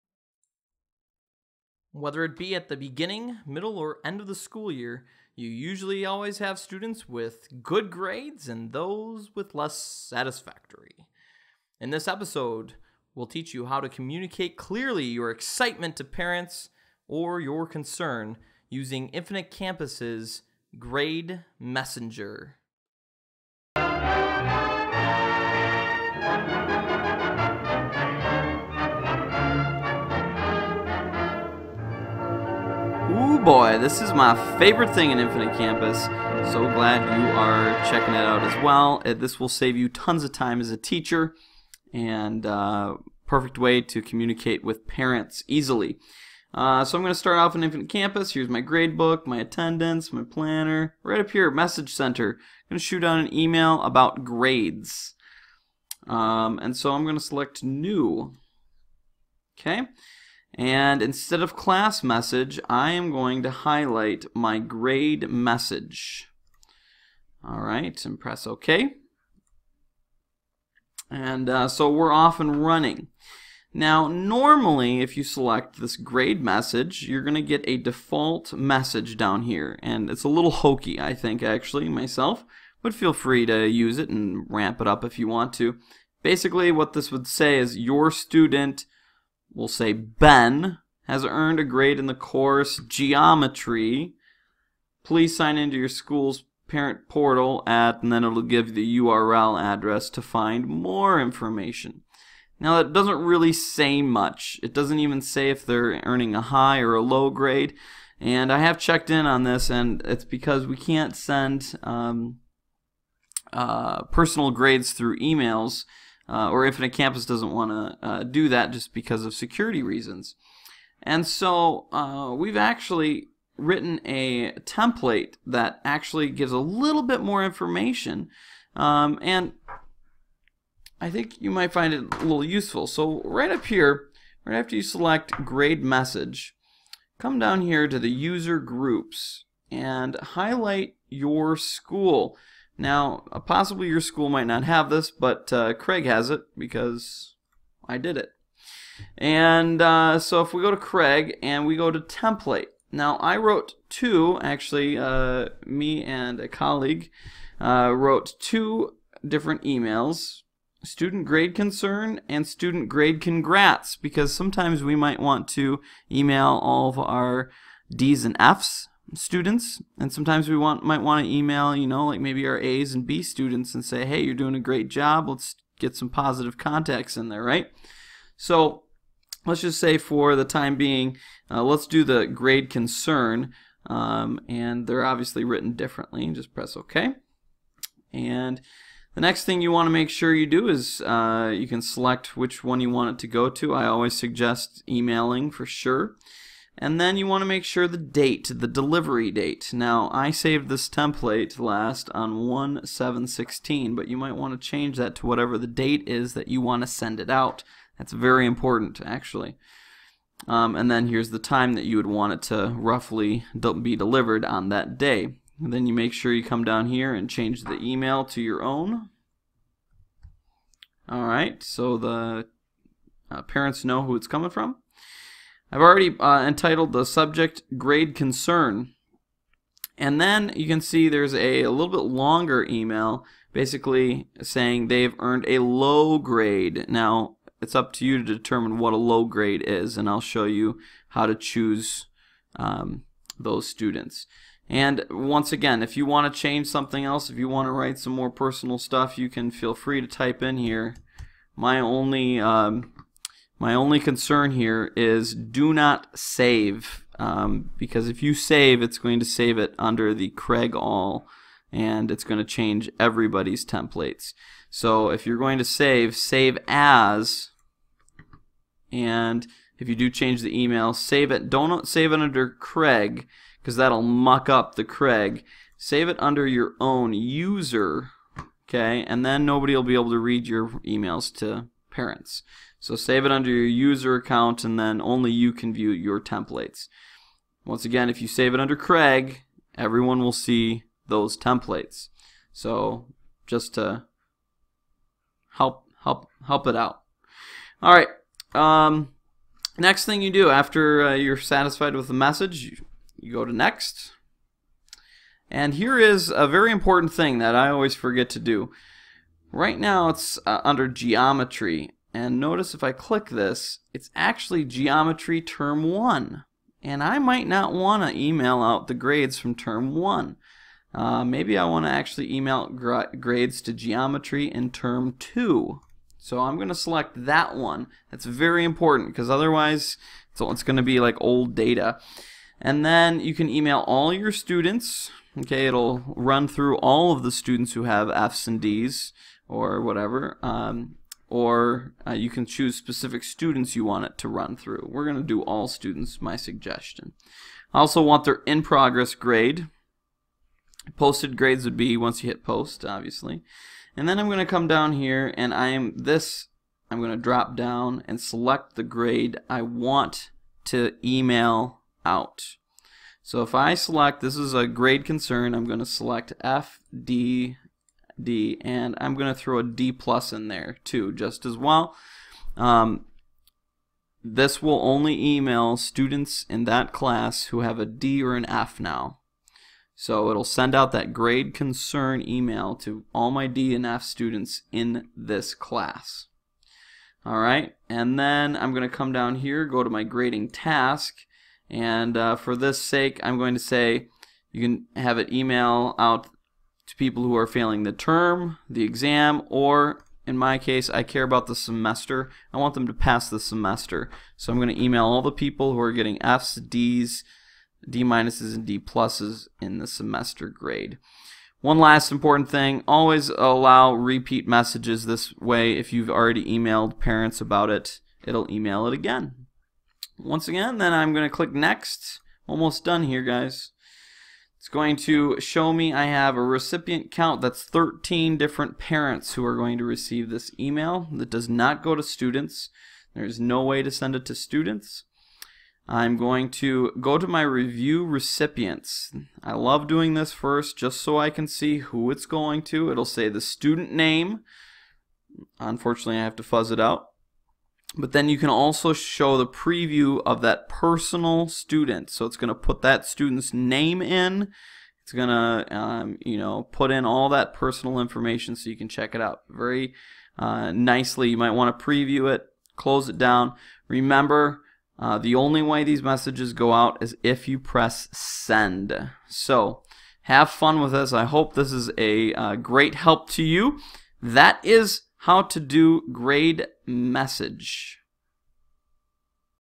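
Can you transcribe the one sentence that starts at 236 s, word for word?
Now, it's up to you to determine what a low grade is, and I'll show you how to choose um, those students.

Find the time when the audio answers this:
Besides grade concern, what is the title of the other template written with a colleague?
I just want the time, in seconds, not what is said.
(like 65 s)
162 s.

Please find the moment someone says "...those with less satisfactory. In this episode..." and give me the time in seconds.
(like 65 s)
8 s.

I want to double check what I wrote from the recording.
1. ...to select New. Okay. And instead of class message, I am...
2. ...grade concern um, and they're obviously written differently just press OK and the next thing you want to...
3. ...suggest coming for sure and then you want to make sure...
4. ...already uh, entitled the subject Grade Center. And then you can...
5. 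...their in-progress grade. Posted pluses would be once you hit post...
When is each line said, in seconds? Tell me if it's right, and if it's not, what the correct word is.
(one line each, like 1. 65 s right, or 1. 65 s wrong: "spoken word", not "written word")
1. 57 s right
2. 182 s right
3. 194 s wrong: "emailing", not "coming"
4. 225 s wrong: "Concern", not "Center"
5. 348 s wrong: "grades", not "pluses".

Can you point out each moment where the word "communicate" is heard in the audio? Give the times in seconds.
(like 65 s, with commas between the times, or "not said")
13 s, 44 s.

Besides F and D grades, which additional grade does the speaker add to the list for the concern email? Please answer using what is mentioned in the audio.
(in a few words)
D plus.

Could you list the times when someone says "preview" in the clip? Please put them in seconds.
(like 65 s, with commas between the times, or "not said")
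449 s, 461 s.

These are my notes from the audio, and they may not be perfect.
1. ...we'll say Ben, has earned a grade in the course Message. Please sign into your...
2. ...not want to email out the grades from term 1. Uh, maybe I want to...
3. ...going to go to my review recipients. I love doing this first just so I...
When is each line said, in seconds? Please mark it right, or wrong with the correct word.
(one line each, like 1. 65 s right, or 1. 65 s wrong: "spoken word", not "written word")
1. 89 s wrong: "Geometry", not "Message"
2. 317 s right
3. 436 s right.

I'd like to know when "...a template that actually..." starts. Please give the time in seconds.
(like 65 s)
124 s.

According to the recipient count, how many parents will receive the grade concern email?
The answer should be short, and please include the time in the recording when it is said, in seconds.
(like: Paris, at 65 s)
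13, at 427 s.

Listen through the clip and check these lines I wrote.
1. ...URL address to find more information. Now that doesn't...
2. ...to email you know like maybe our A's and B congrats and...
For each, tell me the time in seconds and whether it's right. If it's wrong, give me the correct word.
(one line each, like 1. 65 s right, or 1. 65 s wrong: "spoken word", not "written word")
1. 98 s right
2. 171 s wrong: "students", not "congrats".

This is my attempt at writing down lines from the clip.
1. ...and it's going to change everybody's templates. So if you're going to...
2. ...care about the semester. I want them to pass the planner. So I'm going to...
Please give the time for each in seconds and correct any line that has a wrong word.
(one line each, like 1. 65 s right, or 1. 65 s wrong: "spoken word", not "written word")
1. 261 s right
2. 401 s wrong: "semester", not "planner".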